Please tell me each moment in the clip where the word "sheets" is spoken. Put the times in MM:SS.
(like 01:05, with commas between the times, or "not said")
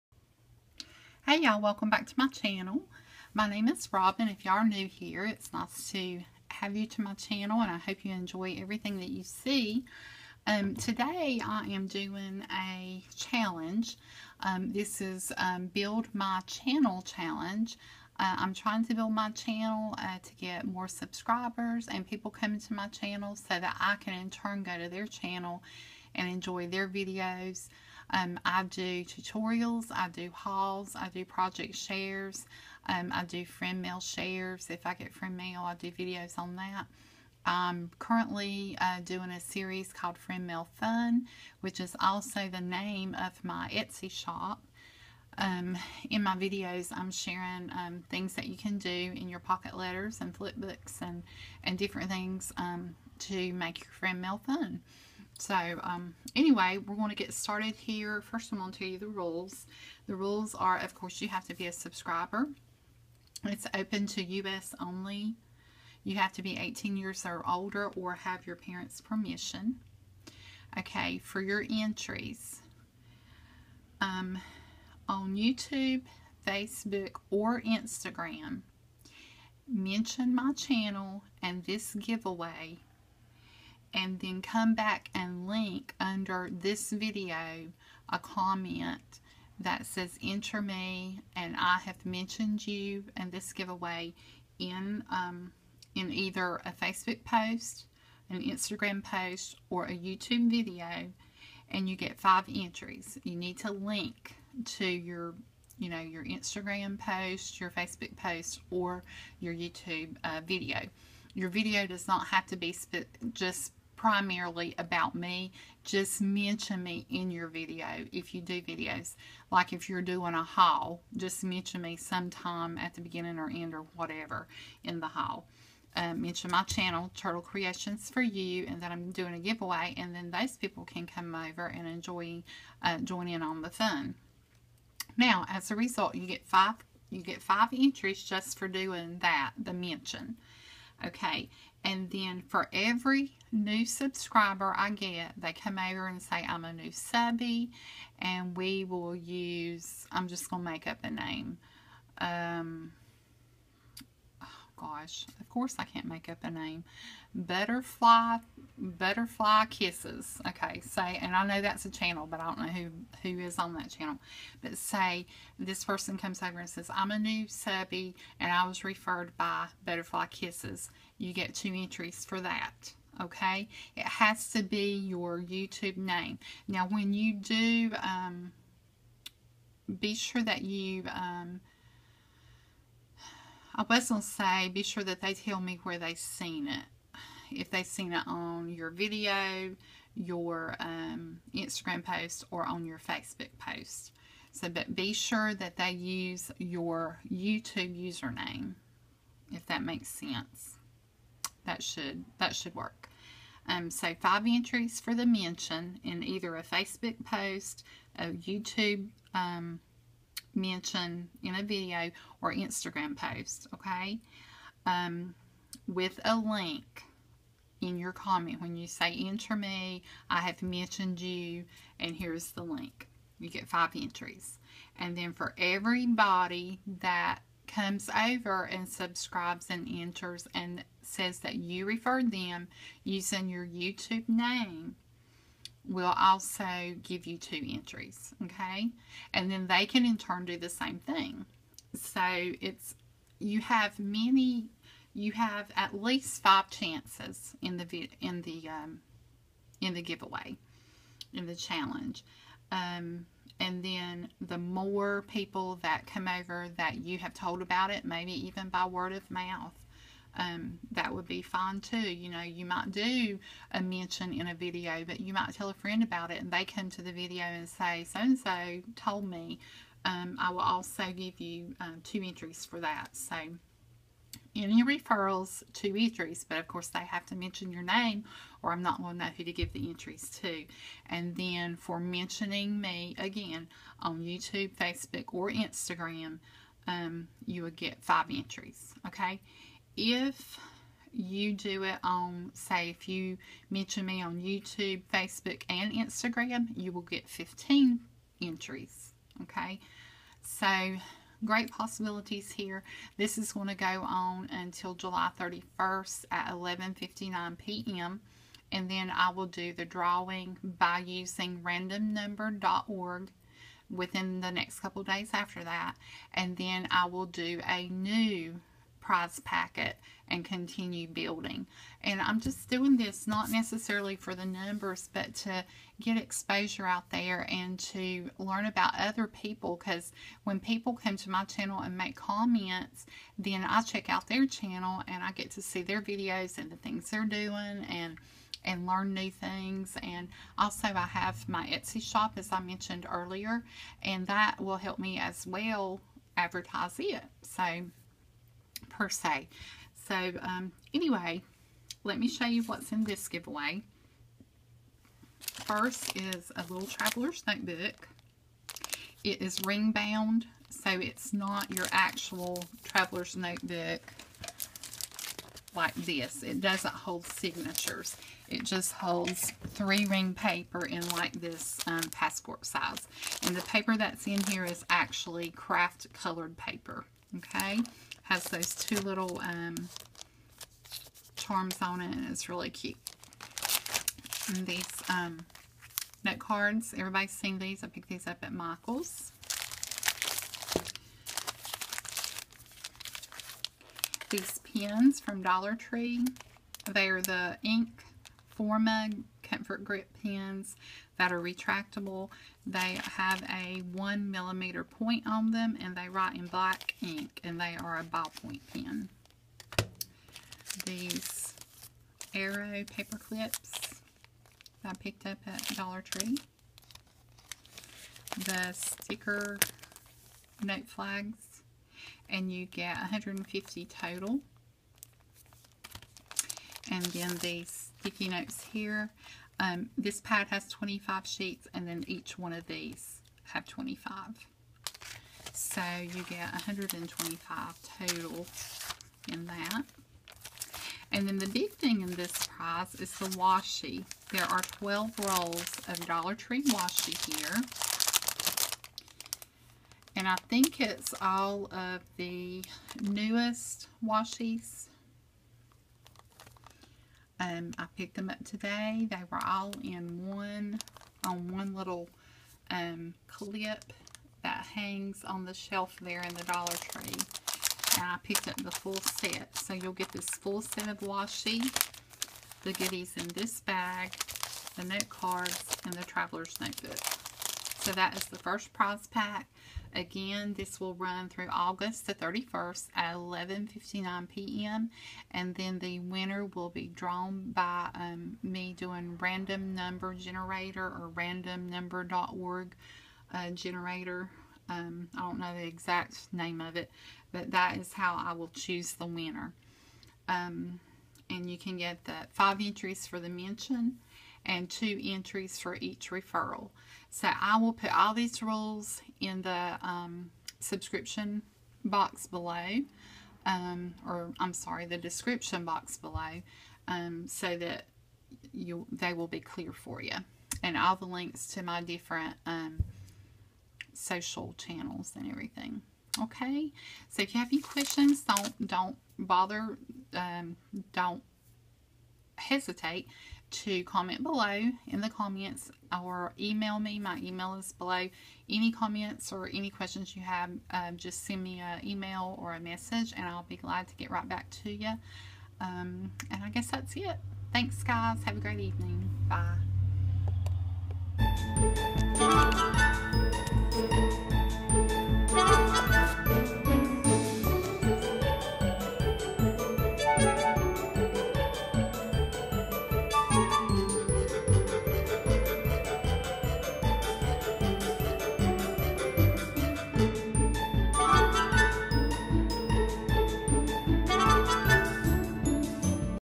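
07:11.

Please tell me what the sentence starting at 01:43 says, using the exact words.
You need to link to your you know your Instagram post, your Facebook post, or your YouTube uh, video.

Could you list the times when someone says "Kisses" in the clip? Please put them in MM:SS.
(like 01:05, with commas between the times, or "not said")
02:39, 02:50.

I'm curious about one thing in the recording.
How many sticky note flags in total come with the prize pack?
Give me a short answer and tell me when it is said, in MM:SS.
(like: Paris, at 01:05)
150, at 07:02.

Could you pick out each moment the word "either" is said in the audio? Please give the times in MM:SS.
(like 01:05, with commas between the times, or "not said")
01:36, 03:26.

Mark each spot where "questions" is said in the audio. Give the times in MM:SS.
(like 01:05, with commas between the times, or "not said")
08:47, 08:59.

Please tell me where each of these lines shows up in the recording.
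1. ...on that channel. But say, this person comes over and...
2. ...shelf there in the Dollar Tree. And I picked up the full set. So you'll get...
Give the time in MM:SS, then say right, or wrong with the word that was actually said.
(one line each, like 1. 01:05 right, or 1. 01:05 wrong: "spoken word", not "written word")
1. 02:43 right
2. 07:45 right.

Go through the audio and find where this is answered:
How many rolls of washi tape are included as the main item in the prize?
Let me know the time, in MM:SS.
07:24.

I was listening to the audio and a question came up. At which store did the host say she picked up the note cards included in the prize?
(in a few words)
Michael's.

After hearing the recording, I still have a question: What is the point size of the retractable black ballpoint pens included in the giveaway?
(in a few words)
1 millimeter.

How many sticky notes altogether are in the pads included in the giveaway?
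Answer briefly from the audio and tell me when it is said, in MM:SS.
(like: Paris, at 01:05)
125, at 07:16.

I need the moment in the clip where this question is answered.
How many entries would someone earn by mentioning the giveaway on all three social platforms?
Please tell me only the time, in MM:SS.
04:57.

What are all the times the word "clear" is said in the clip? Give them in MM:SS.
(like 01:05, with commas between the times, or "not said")
08:39.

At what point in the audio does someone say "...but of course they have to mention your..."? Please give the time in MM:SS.
04:36.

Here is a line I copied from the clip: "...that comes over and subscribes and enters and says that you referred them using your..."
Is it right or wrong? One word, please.
right.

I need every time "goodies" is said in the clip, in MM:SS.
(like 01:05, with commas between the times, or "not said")
07:52.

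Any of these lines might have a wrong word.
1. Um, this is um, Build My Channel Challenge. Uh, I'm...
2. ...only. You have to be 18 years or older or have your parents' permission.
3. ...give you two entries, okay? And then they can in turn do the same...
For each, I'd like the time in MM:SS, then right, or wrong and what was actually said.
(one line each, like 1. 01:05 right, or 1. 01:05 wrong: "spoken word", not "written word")
1. 00:14 right
2. 01:04 right
3. 03:57 right.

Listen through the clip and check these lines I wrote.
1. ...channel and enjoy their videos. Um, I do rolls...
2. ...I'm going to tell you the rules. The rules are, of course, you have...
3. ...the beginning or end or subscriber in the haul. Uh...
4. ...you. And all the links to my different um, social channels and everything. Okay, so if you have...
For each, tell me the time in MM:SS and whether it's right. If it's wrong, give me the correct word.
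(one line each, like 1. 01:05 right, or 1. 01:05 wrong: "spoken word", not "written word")
1. 00:25 wrong: "tutorials", not "rolls"
2. 00:58 right
3. 02:02 wrong: "whatever", not "subscriber"
4. 08:40 right.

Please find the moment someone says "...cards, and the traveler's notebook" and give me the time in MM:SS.
07:55.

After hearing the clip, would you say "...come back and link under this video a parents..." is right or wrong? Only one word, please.
wrong.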